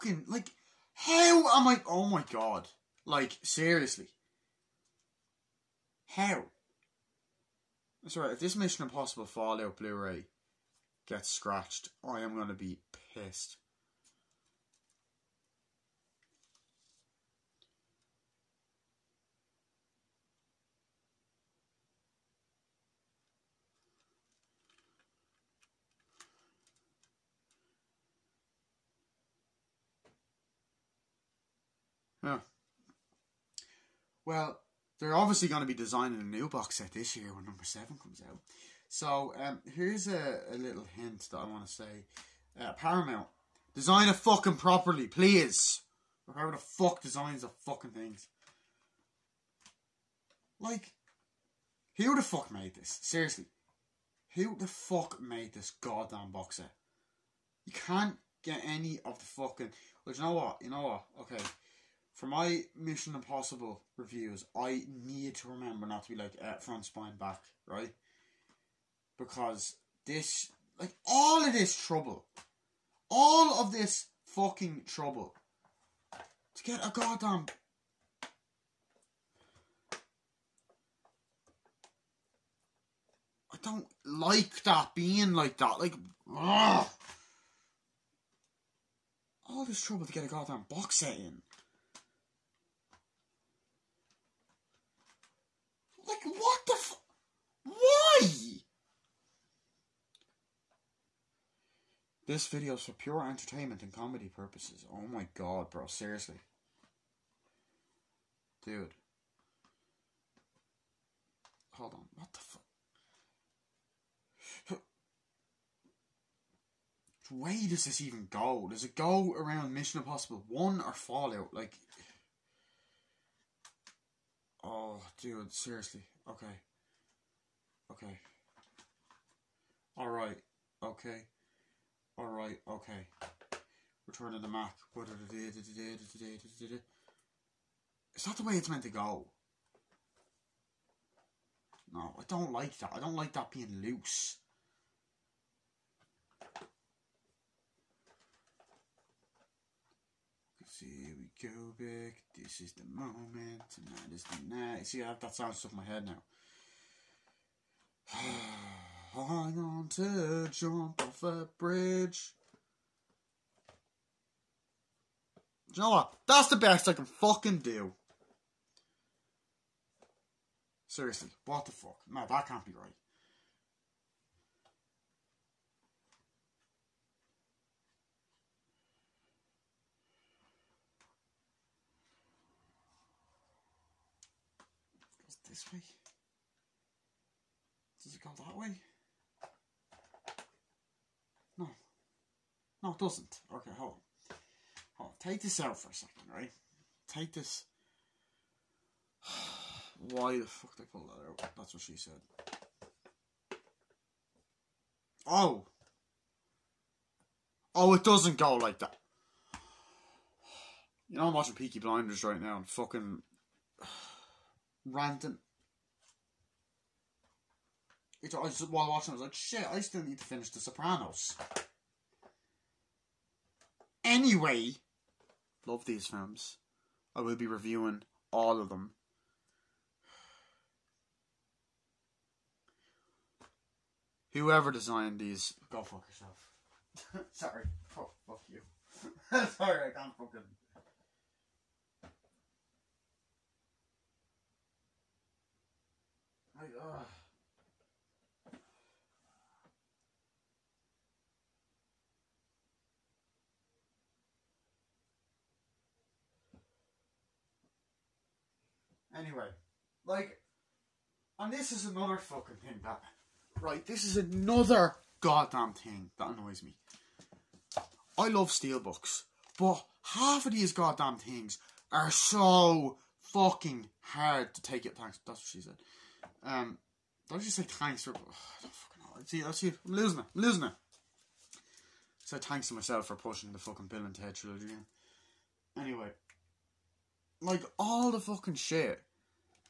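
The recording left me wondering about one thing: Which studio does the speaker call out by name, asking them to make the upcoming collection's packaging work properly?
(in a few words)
Paramount.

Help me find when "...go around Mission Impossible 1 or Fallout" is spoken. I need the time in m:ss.
1:58.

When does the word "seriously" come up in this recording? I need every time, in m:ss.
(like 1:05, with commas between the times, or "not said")
0:03, 0:53, 1:45, 2:05, 2:50.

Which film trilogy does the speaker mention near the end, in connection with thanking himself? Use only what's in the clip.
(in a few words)
Bill and Ted.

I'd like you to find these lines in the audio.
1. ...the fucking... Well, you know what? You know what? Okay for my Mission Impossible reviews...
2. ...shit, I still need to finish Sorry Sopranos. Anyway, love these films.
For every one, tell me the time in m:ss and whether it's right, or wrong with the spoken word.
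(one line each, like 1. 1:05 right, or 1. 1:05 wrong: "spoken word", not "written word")
1. 0:59 right
2. 3:39 wrong: "The", not "Sorry".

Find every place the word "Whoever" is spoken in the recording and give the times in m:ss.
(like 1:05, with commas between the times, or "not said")
0:46, 3:54.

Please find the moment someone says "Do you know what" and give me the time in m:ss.
2:45.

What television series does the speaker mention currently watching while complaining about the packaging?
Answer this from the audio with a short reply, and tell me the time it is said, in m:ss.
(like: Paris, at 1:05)
Peaky Blinders, at 3:31.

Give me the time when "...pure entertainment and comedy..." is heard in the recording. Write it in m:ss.
1:42.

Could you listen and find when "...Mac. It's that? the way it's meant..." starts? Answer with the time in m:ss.
2:14.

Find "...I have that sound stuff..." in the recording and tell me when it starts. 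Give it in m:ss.
2:35.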